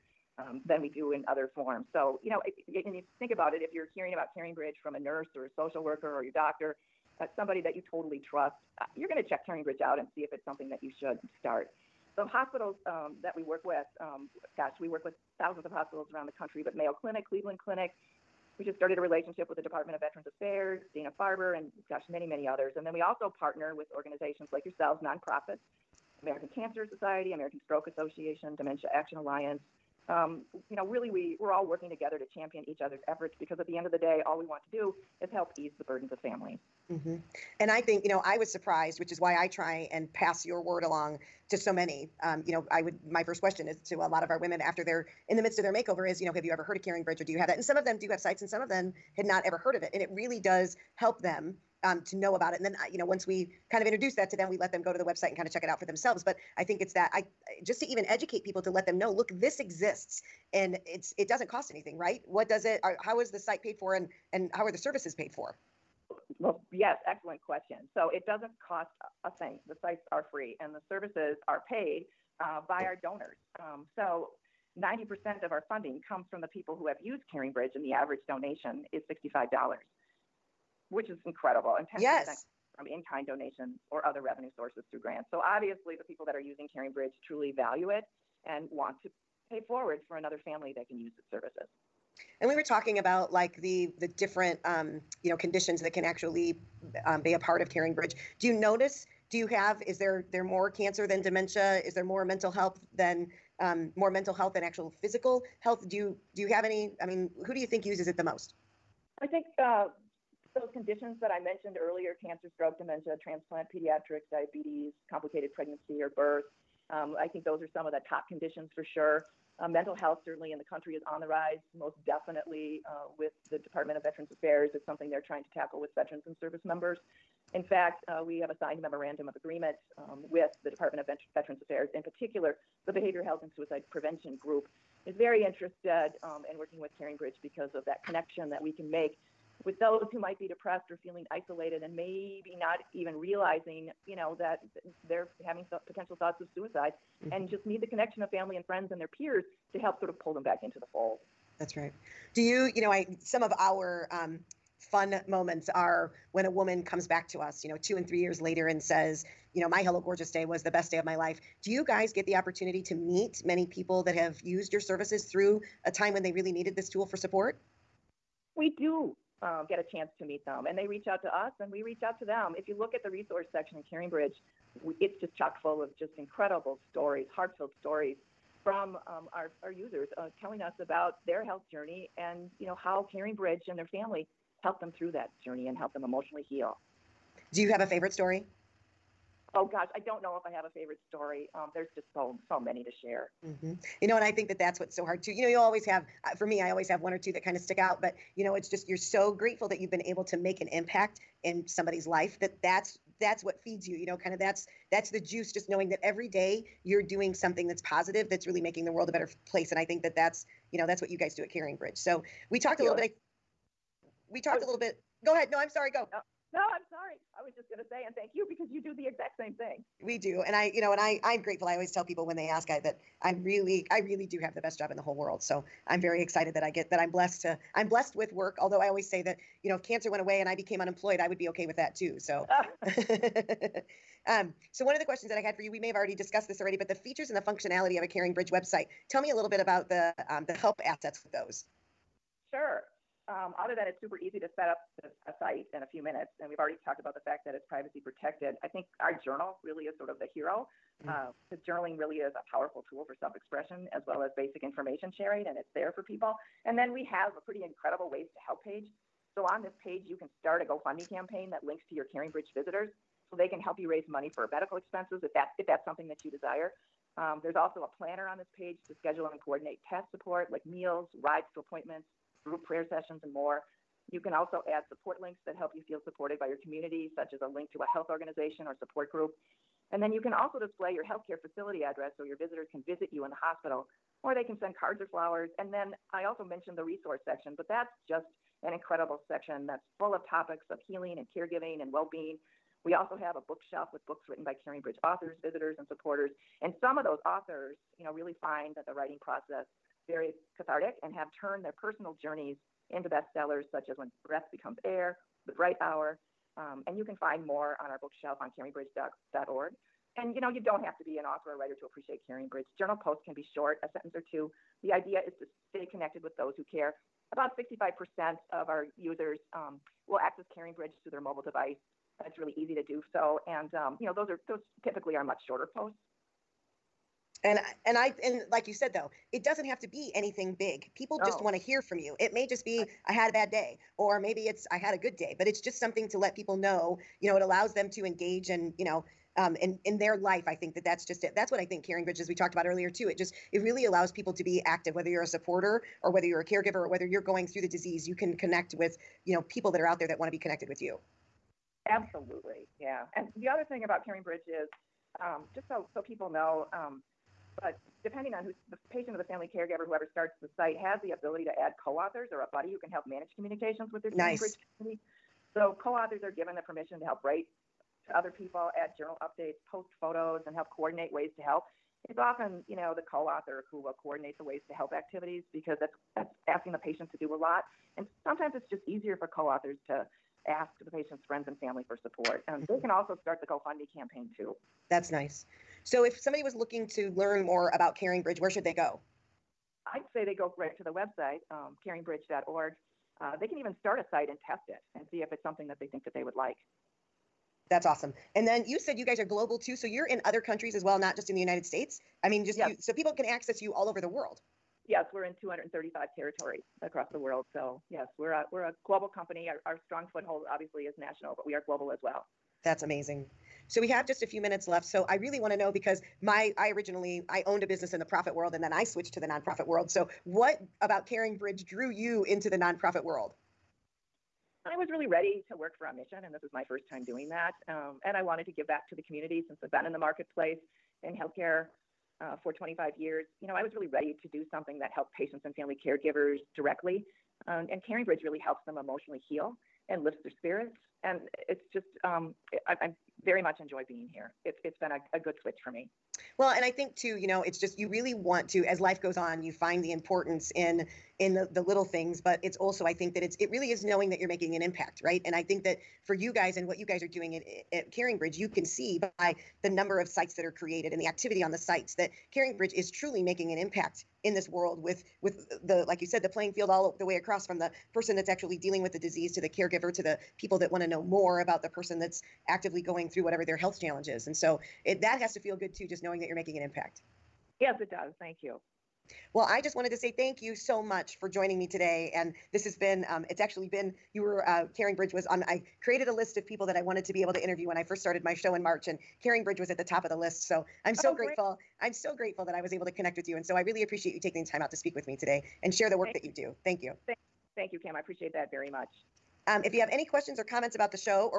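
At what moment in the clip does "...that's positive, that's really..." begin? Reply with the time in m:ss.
3:27.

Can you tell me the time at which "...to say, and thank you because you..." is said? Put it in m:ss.
3:37.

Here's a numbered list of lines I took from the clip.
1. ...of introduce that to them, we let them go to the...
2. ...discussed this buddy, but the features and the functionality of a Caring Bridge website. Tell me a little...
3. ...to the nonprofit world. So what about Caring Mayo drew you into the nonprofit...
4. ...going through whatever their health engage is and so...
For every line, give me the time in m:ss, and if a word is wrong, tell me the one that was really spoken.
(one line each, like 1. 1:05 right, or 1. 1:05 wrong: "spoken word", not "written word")
1. 0:53 right
2. 3:56 wrong: "already", not "buddy"
3. 6:59 wrong: "Bridge", not "Mayo"
4. 7:52 wrong: "challenge", not "engage".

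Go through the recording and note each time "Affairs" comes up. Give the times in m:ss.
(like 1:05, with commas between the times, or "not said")
0:20, 2:04, 2:11.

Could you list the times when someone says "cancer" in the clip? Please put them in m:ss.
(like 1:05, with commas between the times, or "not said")
0:26, 1:40, 1:52, 3:49.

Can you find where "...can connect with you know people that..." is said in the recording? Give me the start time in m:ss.
5:48.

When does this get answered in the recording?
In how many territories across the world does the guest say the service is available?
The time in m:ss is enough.
6:45.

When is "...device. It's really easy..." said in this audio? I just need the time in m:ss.
5:21.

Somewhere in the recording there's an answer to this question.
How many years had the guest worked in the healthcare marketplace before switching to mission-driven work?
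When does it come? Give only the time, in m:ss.
7:12.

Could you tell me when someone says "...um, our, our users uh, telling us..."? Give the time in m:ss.
2:59.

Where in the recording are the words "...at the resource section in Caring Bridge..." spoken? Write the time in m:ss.
2:52.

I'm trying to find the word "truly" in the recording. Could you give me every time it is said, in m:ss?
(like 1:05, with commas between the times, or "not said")
1:27, 7:42.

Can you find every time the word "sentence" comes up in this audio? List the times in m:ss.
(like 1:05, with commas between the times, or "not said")
5:13.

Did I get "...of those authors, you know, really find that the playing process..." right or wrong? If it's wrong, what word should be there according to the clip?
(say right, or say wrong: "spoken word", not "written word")
wrong: "writing", not "playing".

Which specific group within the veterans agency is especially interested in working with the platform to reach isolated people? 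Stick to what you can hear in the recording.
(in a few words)
Behavior Health and Suicide Prevention Group.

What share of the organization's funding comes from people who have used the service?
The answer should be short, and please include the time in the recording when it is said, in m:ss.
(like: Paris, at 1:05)
90%, at 1:14.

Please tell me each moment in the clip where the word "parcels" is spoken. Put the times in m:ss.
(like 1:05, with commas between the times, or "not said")
not said.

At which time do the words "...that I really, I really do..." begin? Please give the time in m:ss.
3:42.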